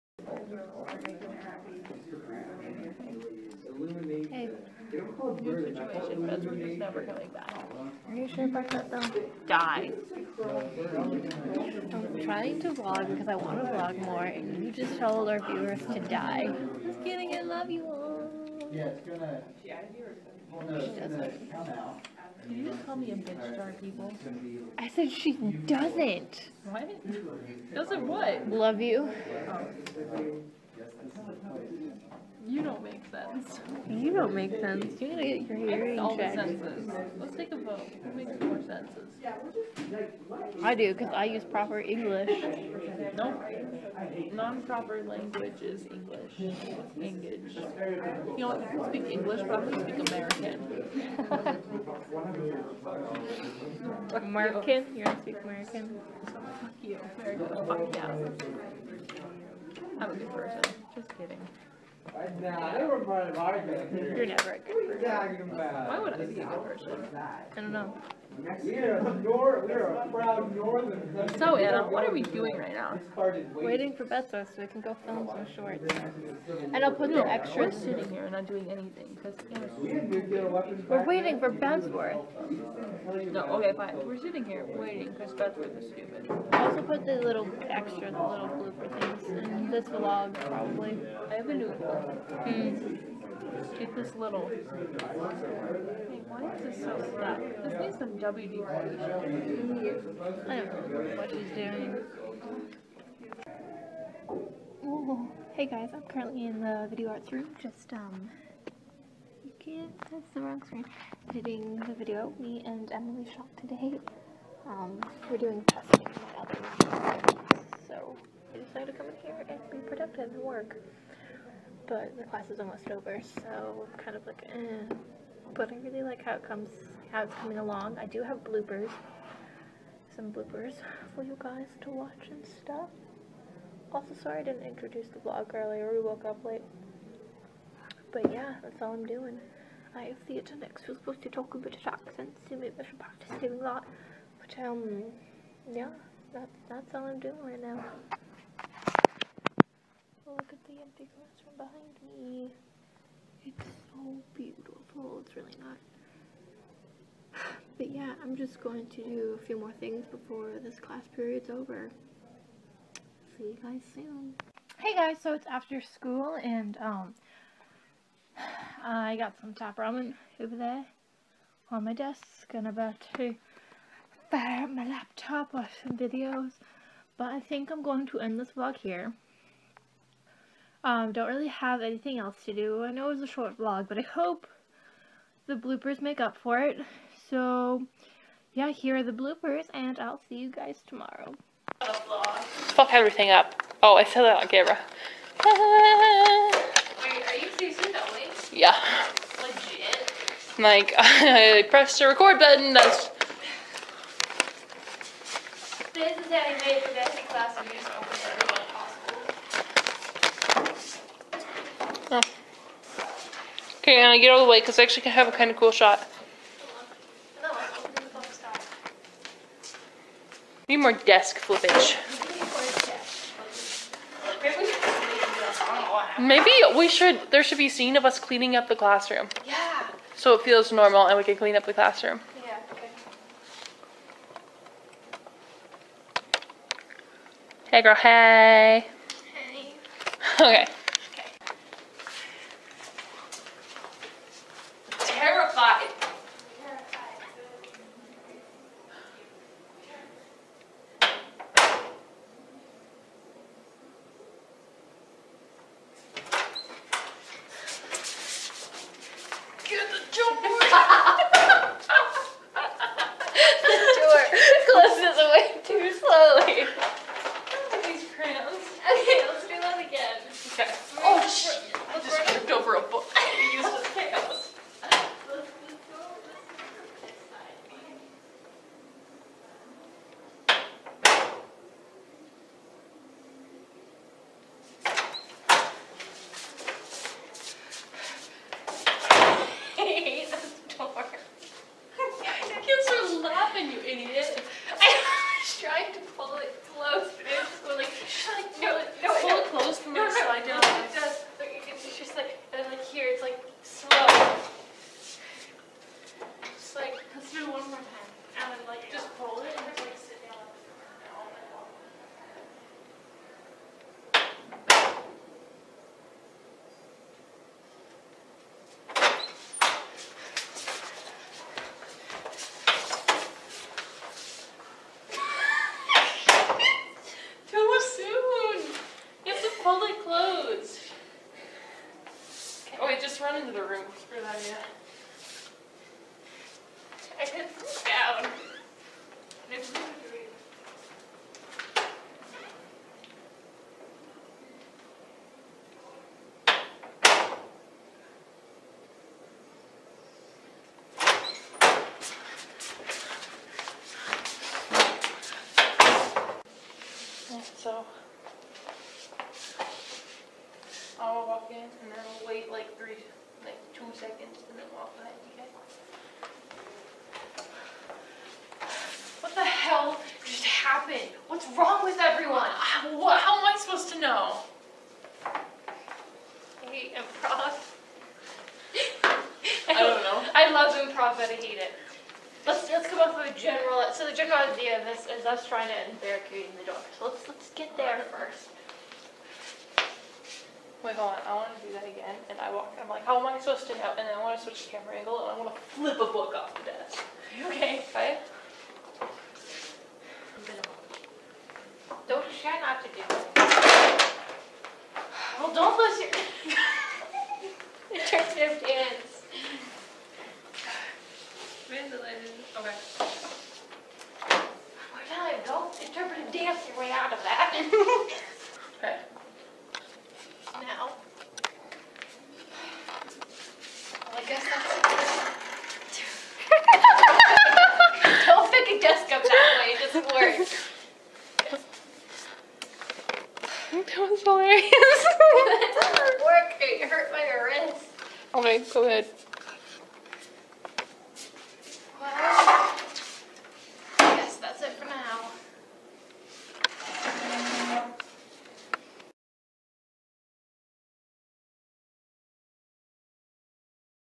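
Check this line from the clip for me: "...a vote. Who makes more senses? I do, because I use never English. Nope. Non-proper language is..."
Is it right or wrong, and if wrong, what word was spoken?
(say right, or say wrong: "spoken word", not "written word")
wrong: "proper", not "never".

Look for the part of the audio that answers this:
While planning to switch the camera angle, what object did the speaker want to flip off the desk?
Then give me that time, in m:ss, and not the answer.
6:35.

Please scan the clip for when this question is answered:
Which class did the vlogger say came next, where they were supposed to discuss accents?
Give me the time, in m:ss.
2:20.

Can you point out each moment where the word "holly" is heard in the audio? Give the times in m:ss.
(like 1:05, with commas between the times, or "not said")
not said.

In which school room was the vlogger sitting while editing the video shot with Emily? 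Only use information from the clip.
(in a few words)
video arts room.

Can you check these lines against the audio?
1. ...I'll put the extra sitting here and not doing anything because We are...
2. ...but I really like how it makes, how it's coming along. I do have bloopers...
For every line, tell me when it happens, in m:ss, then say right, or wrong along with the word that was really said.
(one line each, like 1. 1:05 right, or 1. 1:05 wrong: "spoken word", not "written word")
1. 1:16 right
2. 2:05 wrong: "comes", not "makes".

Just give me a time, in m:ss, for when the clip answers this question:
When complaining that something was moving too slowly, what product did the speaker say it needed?
1:38.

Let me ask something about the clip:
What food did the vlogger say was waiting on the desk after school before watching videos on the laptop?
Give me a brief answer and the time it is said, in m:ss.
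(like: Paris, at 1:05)
top ramen, at 2:49.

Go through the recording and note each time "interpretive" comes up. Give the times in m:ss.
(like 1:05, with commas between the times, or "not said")
6:47, 6:55.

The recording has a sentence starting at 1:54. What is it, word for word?
Um we're doing testing So I decided to come in here and be productive and work.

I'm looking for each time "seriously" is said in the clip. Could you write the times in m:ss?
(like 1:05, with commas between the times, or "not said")
3:17.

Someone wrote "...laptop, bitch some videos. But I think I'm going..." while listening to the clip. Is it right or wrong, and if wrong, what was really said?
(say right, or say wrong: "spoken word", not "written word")
wrong: "watch", not "bitch".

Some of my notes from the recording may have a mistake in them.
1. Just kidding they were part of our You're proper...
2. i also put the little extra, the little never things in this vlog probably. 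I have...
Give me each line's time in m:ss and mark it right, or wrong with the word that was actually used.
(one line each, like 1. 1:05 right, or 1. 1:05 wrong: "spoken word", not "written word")
1. 1:00 wrong: "never", not "proper"
2. 1:26 wrong: "blooper", not "never".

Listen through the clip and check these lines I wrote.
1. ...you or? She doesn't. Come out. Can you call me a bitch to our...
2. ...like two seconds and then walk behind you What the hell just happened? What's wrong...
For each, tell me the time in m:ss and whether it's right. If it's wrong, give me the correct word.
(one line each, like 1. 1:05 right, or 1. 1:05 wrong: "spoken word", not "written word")
1. 0:19 right
2. 6:03 right.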